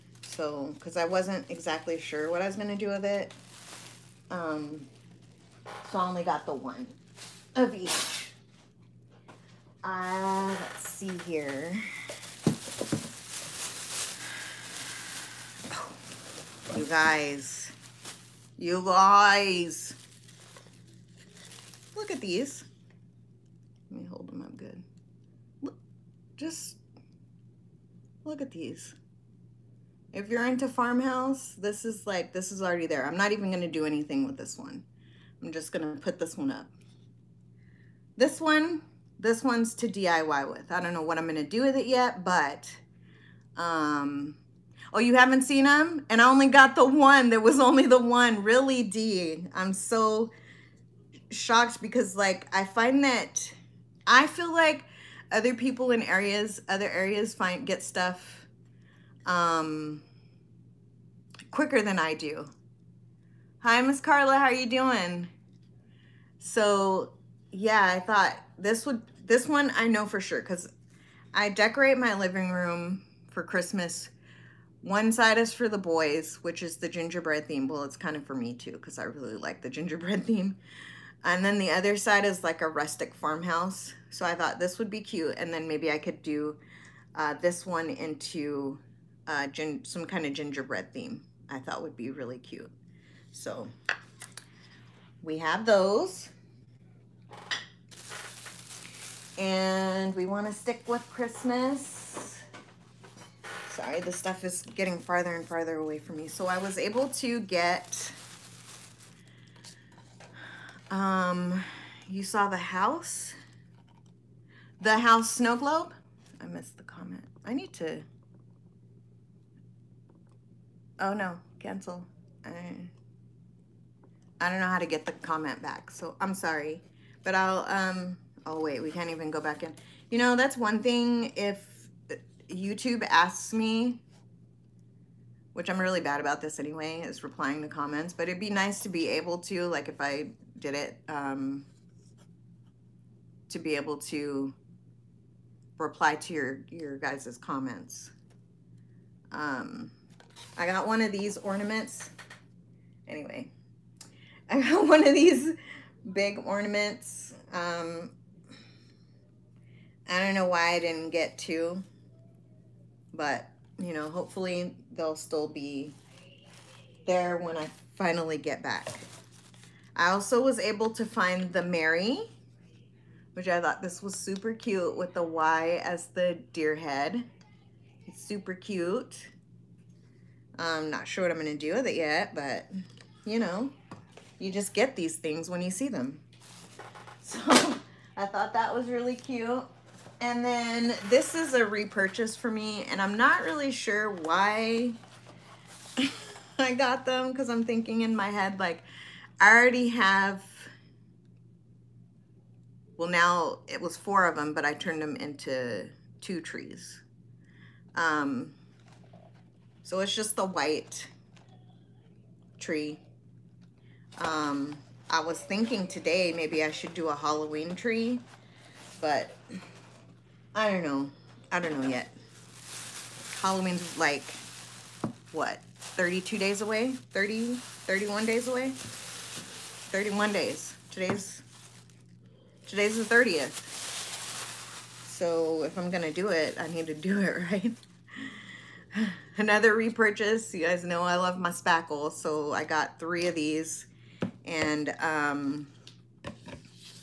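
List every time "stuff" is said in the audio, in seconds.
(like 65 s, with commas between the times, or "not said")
57 s, 104 s.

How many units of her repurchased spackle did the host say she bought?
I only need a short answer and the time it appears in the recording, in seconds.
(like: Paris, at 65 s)
3, at 242 s.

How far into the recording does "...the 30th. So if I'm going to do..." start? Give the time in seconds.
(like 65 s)
233 s.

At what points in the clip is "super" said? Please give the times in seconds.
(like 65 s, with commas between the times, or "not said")
174 s, 178 s.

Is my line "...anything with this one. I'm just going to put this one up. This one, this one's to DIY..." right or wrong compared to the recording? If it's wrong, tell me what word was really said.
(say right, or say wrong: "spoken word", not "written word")
right.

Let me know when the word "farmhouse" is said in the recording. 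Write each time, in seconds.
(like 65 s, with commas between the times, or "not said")
30 s, 83 s.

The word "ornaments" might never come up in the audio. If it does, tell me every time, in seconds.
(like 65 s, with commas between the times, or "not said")
151 s, 156 s.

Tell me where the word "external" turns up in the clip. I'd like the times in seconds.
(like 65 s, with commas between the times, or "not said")
not said.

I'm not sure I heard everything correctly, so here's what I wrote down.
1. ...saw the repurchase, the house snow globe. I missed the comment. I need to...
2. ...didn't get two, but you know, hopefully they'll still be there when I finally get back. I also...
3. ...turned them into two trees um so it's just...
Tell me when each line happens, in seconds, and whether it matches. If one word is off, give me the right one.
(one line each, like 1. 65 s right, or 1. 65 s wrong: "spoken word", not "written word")
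1. 112 s wrong: "house", not "repurchase"
2. 160 s right
3. 204 s right.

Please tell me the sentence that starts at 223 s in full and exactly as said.
Halloween's like, what, 32 days away?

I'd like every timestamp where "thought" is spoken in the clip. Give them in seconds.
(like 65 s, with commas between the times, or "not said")
67 s, 84 s, 91 s, 173 s, 188 s.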